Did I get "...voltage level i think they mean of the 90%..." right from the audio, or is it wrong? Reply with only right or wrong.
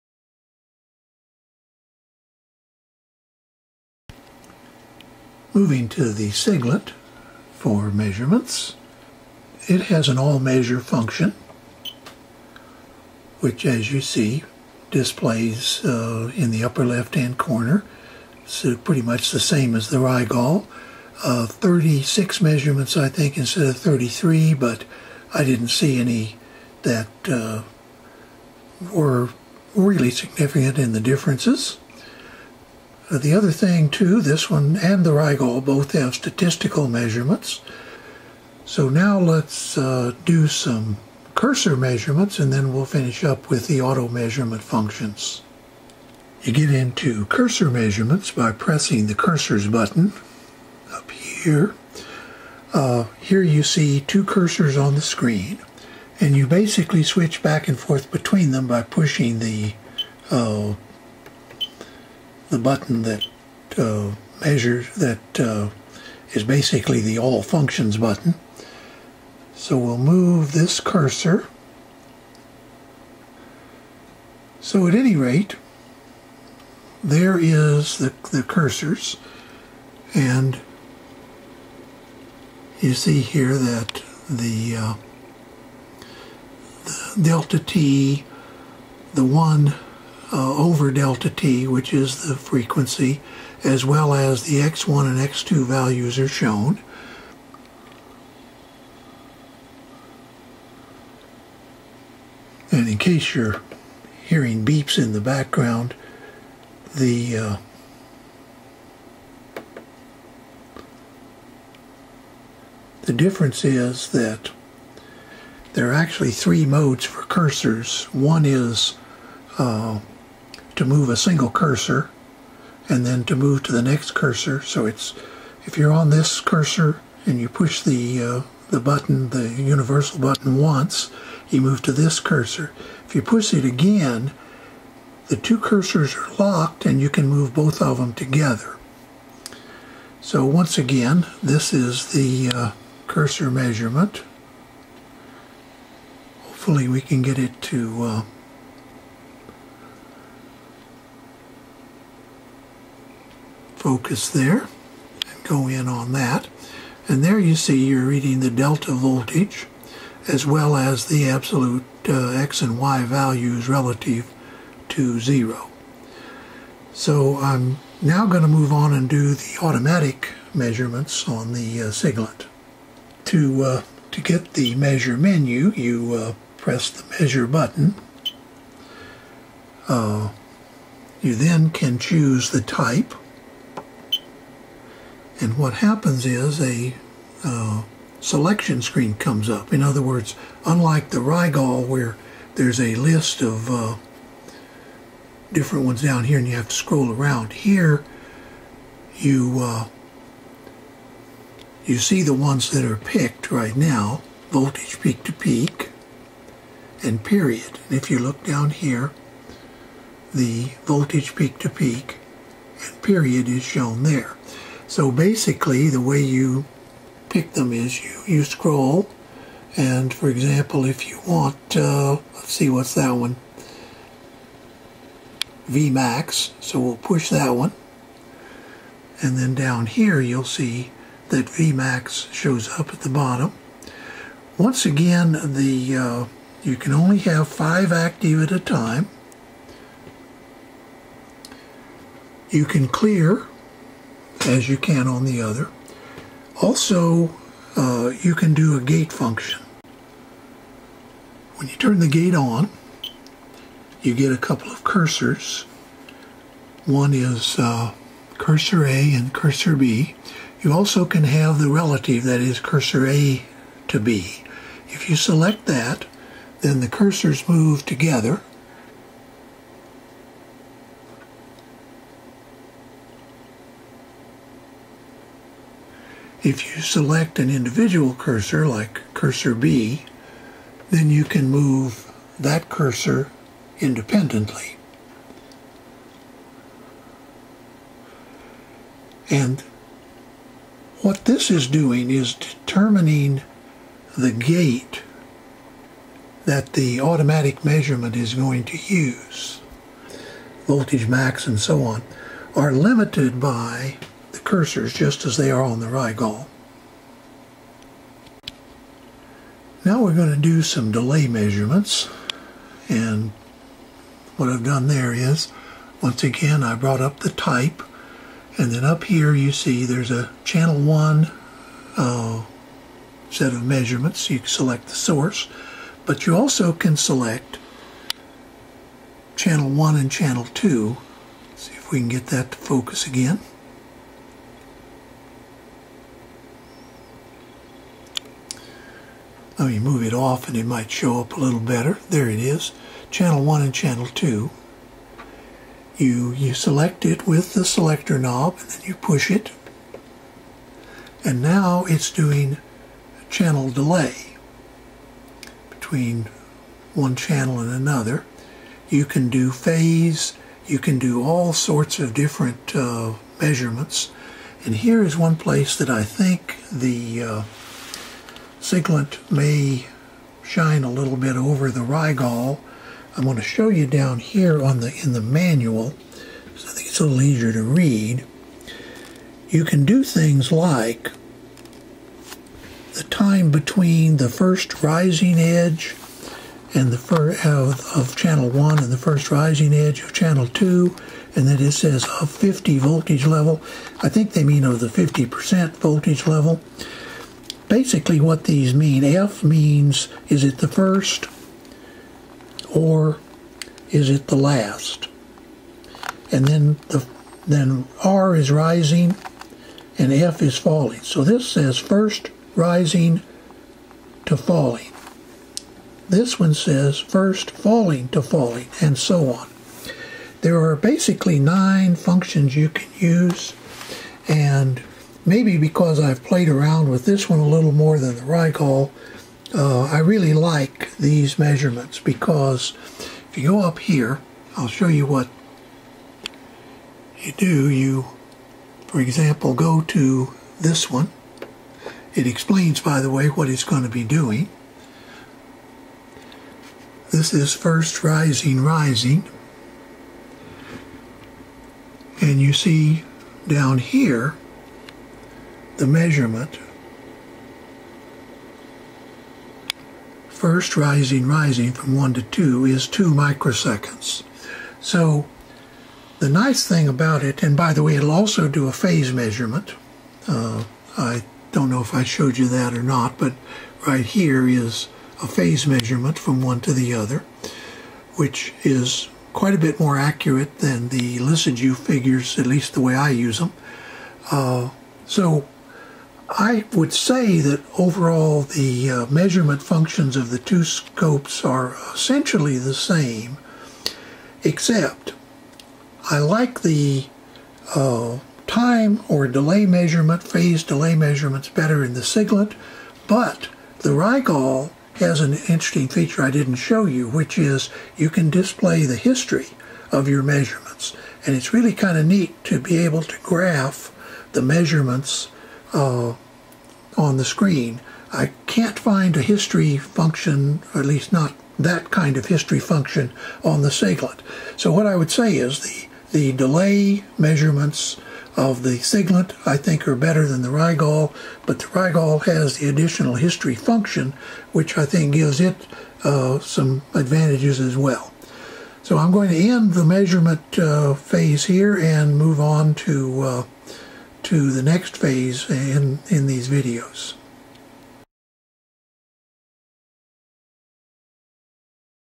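wrong.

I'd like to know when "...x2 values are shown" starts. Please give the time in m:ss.
1:35.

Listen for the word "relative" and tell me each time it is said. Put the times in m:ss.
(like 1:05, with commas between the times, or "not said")
2:43, 4:21.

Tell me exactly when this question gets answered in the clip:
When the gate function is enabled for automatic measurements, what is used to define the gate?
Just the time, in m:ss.
4:14.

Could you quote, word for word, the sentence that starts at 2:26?
Hopefully we can get it to uh, focus there and go in on that.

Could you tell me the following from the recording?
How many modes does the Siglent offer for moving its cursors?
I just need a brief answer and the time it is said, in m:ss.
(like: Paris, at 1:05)
3, at 1:56.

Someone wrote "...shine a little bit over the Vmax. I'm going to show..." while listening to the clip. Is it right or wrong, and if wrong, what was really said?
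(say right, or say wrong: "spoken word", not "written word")
wrong: "Rigol", not "Vmax".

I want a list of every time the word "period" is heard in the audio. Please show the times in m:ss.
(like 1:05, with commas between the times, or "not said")
3:27, 3:33.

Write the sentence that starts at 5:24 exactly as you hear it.
You select the source but you also can select channel 1 and channel 2.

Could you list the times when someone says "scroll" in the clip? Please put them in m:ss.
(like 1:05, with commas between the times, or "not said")
3:16, 3:38.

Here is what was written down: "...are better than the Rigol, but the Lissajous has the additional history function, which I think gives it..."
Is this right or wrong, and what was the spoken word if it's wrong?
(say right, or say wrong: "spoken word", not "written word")
wrong: "Rigol", not "Lissajous".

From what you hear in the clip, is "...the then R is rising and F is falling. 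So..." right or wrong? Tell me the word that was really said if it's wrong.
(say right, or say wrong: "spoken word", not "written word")
right.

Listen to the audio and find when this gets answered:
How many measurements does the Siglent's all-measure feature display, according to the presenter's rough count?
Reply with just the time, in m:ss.
0:21.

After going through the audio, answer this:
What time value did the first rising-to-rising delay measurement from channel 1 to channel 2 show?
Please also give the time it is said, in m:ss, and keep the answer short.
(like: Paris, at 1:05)
2 microseconds, at 7:42.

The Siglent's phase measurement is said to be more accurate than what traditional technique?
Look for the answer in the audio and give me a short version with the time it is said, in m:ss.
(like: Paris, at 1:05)
Lissajous figures, at 8:01.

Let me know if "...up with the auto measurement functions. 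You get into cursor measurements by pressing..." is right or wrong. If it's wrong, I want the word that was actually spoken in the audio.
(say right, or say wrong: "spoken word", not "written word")
right.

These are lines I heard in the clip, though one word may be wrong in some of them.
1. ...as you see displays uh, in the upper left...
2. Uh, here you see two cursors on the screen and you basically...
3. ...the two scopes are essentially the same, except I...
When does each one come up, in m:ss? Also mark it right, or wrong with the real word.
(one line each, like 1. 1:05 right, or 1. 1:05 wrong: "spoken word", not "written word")
1. 0:13 right
2. 0:52 right
3. 8:10 right.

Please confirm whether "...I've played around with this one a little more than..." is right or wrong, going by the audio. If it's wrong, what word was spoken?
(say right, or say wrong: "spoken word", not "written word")
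right.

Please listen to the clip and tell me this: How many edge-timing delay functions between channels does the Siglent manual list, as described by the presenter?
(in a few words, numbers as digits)
9.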